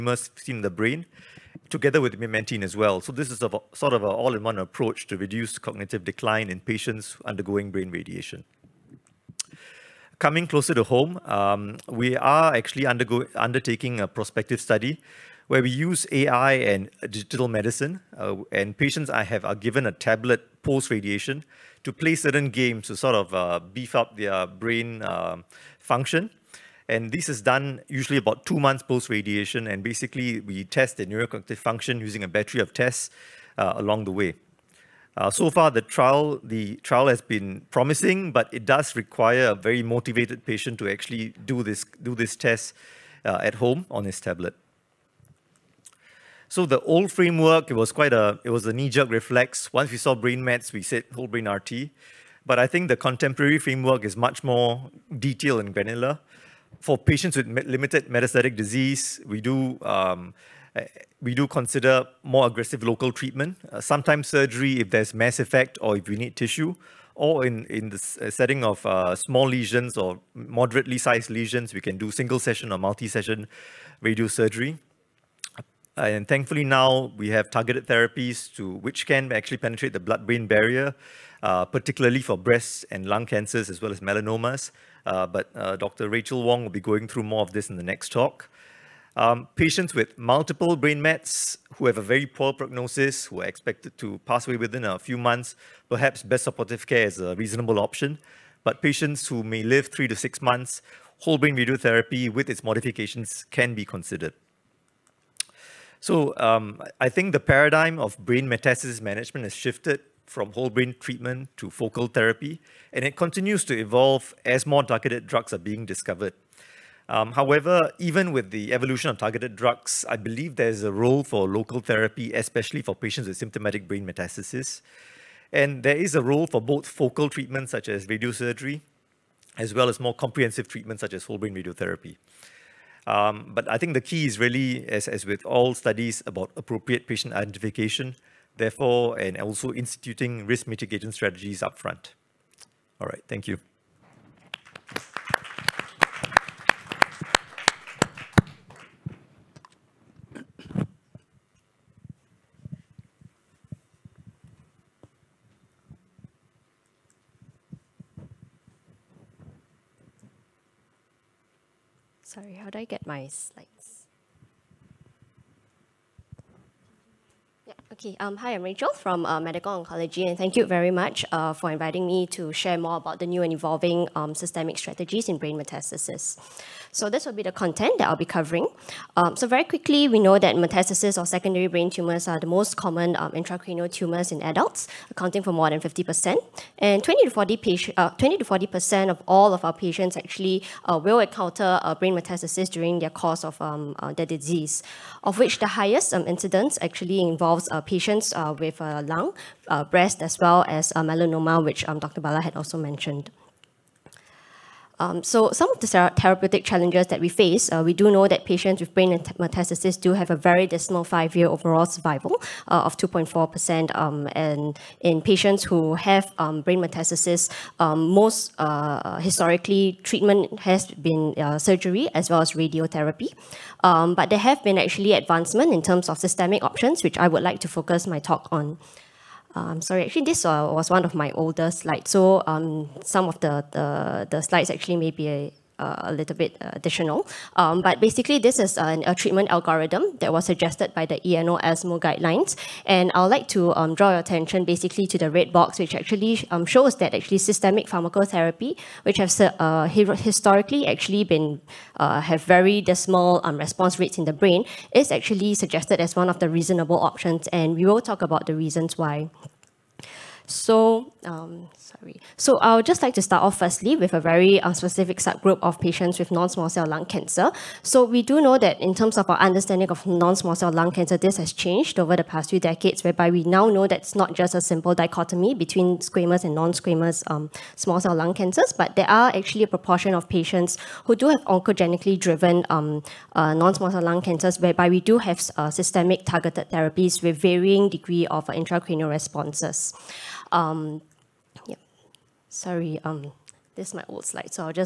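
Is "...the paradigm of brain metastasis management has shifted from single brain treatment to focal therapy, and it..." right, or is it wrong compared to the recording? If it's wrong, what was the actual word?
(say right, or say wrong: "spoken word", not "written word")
wrong: "whole", not "single".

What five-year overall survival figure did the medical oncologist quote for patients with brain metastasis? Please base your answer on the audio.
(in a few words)
2.4%.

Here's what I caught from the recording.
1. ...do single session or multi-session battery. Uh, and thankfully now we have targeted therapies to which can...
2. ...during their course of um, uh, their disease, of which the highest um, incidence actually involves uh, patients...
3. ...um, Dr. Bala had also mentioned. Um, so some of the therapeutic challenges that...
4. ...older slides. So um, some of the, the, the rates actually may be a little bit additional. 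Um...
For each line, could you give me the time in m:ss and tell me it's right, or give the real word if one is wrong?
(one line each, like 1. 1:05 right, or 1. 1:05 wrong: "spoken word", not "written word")
1. 1:11 wrong: "radiosurgery", not "battery"
2. 3:12 right
3. 3:21 right
4. 3:51 wrong: "slides", not "rates".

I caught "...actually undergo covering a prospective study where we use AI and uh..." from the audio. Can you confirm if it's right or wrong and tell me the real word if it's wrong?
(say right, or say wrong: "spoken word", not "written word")
wrong: "undertaking", not "covering".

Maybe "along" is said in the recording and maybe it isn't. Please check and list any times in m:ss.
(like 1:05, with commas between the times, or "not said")
0:33.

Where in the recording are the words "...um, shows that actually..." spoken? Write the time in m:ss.
4:06.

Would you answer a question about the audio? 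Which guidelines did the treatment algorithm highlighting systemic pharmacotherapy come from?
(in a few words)
EANO ESMO.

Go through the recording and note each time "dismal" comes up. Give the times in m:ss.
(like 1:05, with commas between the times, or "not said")
3:30, 4:12.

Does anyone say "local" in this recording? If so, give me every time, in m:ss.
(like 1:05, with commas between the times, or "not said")
1:02, 2:01.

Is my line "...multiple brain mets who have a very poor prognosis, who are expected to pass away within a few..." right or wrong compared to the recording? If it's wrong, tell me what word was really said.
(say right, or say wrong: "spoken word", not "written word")
right.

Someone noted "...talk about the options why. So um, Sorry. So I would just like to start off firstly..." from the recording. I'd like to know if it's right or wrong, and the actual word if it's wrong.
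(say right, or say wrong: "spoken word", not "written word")
wrong: "reasons", not "options".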